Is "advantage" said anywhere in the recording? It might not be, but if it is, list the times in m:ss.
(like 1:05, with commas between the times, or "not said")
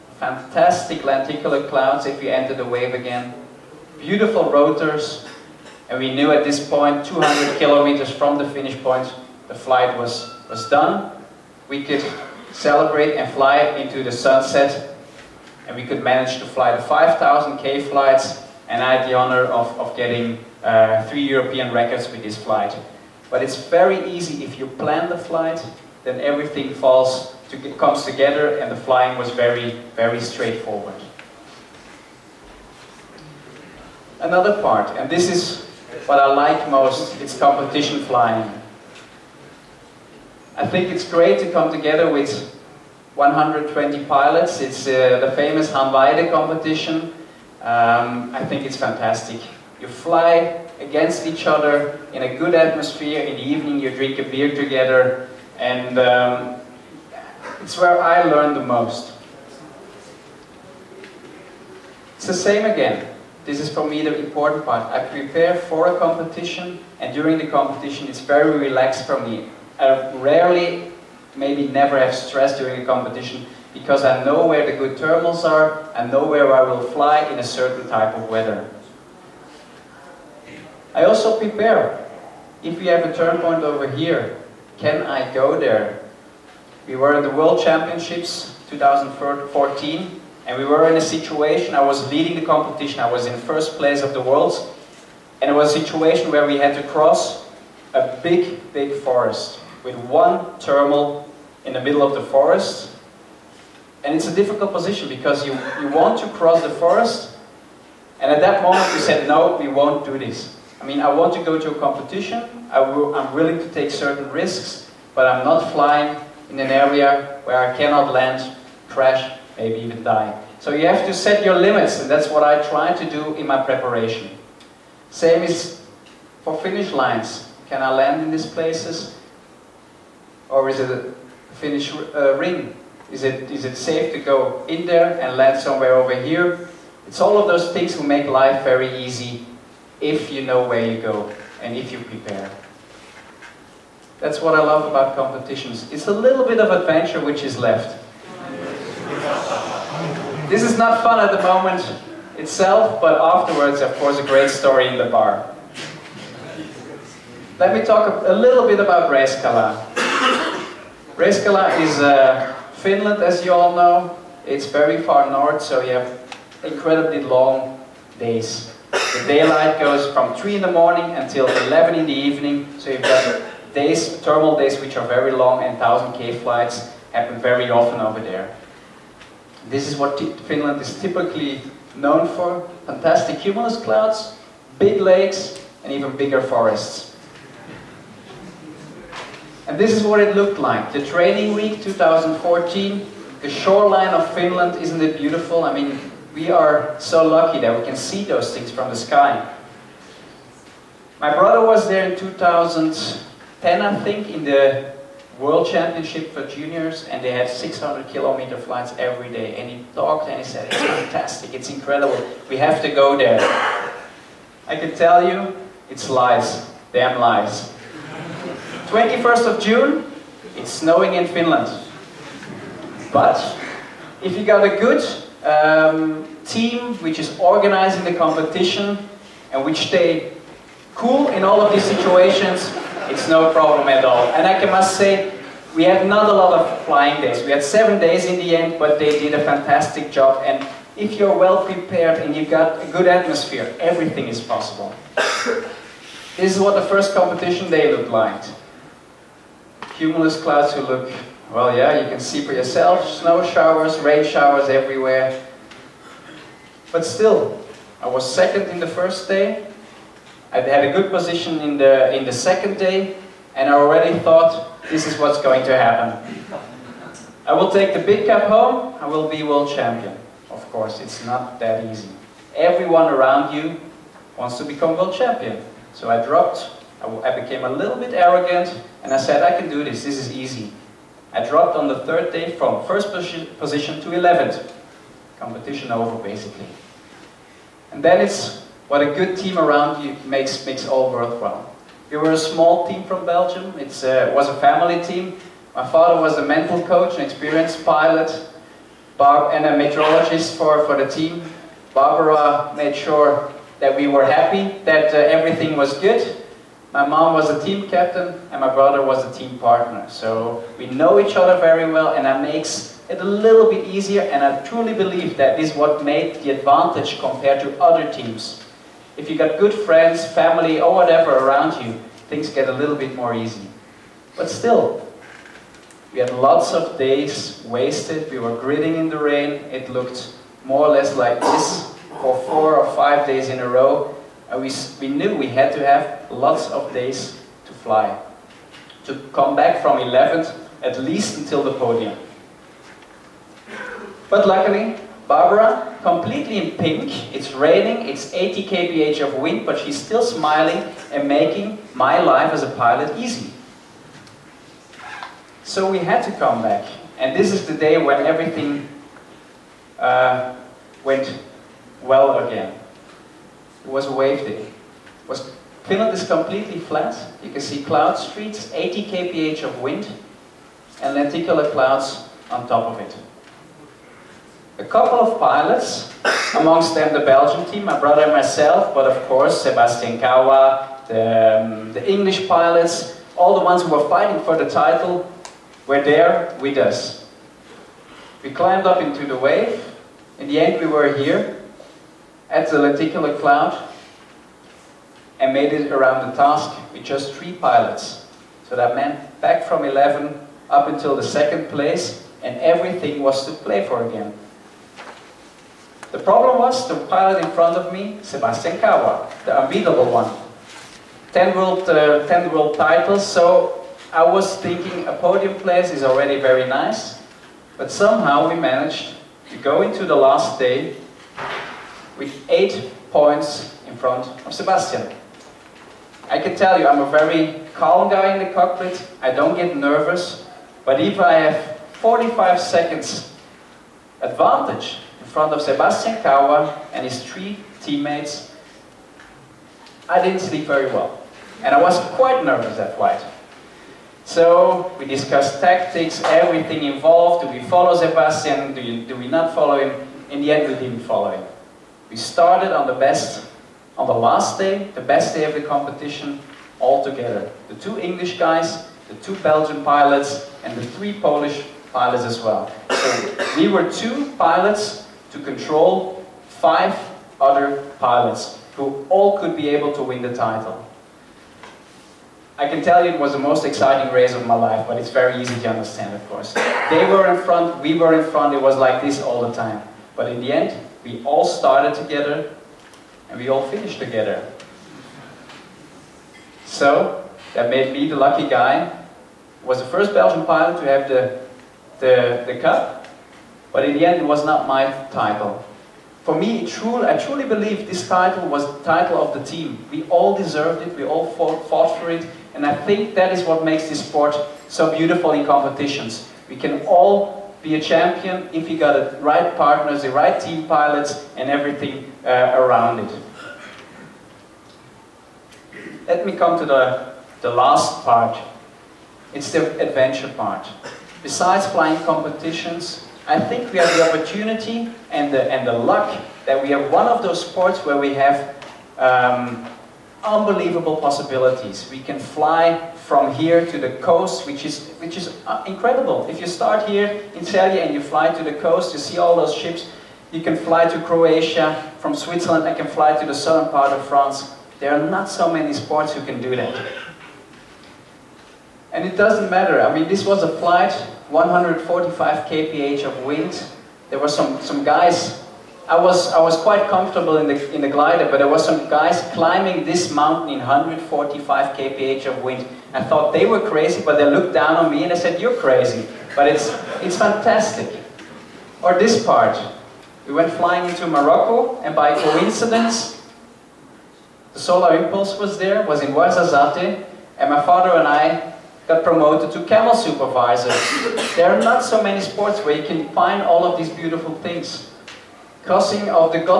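5:16, 7:14.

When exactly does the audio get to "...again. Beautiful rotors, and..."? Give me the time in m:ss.
0:02.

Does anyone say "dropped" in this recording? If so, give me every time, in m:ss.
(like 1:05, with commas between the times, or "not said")
4:36, 4:41.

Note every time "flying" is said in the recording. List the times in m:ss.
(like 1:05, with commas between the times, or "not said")
0:28, 0:38, 1:55, 3:56, 8:41, 9:30.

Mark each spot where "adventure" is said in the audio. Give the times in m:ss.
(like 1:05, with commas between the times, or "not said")
2:26, 8:39.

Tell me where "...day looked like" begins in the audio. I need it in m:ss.
4:07.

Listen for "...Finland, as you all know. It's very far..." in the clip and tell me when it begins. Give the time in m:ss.
2:42.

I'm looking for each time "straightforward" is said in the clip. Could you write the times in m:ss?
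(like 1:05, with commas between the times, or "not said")
0:30.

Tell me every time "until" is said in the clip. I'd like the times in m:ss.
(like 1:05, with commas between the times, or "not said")
2:51, 5:41, 6:40.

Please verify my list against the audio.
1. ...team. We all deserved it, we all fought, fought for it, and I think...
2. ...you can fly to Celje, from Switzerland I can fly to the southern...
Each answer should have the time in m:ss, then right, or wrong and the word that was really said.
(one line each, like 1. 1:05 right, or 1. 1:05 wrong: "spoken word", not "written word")
1. 8:19 right
2. 9:00 wrong: "Croatia", not "Celje".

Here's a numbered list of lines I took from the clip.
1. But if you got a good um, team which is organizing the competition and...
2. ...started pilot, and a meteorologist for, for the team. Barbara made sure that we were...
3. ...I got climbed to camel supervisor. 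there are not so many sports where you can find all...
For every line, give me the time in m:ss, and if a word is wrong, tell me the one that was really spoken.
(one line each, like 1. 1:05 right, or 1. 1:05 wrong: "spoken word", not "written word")
1. 3:43 right
2. 4:57 wrong: "experienced", not "started"
3. 9:38 wrong: "promoted", not "climbed".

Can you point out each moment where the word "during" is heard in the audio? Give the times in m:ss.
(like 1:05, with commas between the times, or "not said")
1:07, 1:12.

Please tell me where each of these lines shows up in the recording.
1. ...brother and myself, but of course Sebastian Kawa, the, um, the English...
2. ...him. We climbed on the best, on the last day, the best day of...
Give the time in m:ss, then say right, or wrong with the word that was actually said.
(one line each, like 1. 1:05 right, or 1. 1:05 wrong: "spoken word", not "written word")
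1. 6:18 right
2. 7:31 wrong: "started", not "climbed".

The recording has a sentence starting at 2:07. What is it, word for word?
Can I land in these places?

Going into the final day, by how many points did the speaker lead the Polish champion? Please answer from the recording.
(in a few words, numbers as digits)
8.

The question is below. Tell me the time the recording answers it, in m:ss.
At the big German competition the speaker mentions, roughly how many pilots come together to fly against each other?
0:43.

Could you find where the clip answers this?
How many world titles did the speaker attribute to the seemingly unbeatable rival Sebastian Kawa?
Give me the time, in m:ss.
6:52.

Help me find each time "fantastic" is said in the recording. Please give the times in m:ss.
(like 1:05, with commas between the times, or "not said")
0:00, 0:48, 3:02, 3:30, 3:59, 9:27.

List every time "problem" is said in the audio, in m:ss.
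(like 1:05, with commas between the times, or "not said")
3:53, 6:46.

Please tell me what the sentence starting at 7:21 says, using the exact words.
And I was quite nervous that night.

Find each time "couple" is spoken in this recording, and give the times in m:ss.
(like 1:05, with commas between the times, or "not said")
6:14.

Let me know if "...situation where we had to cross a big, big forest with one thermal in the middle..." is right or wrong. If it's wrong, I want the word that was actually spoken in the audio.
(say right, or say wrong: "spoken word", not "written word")
right.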